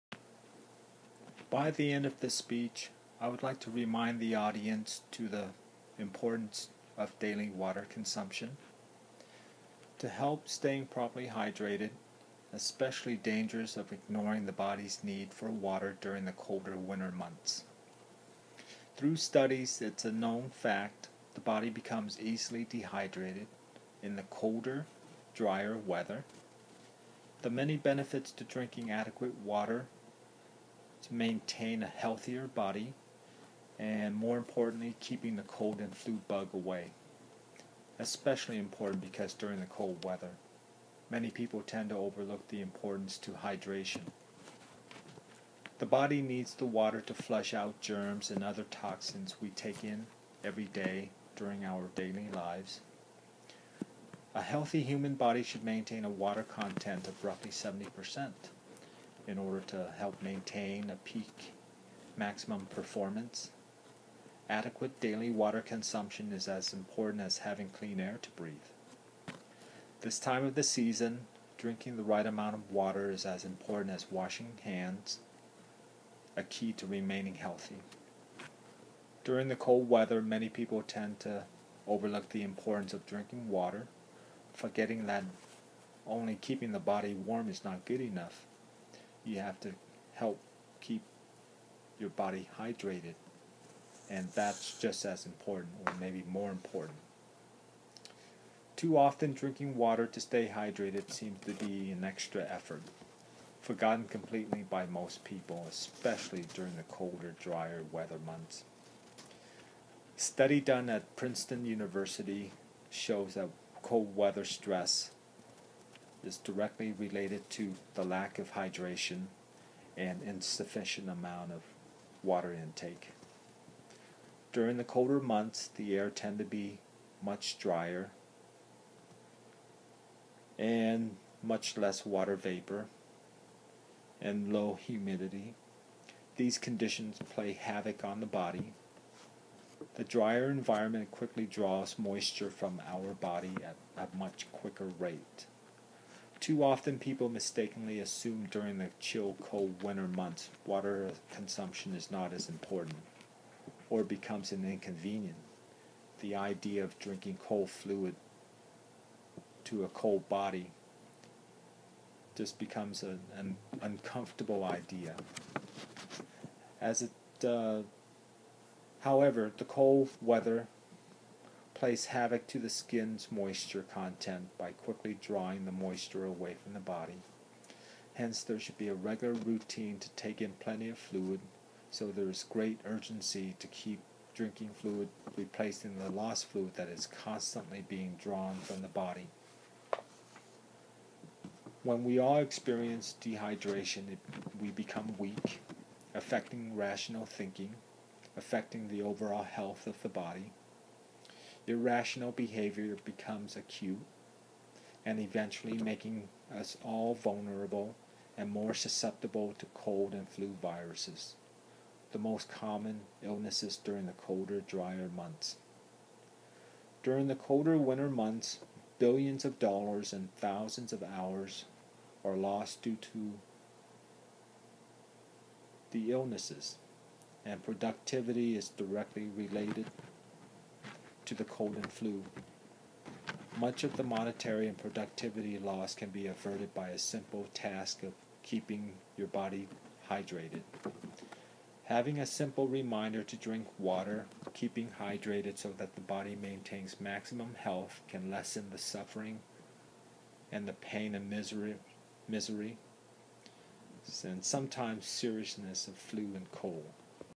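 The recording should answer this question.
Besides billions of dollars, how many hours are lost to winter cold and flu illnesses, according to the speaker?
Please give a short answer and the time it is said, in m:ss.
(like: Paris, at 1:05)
thousands of hours, at 3:40.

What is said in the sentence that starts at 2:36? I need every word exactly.
The idea of drinking cold fluid to a cold body just becomes an, an uncomfortable idea.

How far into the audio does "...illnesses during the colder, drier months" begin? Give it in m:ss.
3:33.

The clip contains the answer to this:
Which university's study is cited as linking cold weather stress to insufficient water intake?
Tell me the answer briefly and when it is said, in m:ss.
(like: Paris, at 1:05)
Princeton University, at 1:51.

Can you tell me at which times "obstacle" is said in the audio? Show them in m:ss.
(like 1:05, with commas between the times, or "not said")
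not said.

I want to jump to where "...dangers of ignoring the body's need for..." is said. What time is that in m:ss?
0:13.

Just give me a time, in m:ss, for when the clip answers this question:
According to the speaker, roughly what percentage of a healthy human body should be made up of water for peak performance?
0:57.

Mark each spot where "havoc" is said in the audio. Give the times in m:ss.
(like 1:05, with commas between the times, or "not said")
2:17, 2:52.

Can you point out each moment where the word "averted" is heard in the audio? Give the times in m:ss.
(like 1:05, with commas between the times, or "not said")
3:56.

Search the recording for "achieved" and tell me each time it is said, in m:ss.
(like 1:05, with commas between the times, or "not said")
not said.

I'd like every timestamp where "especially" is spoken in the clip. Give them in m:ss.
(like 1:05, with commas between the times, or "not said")
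0:12, 0:37, 1:45.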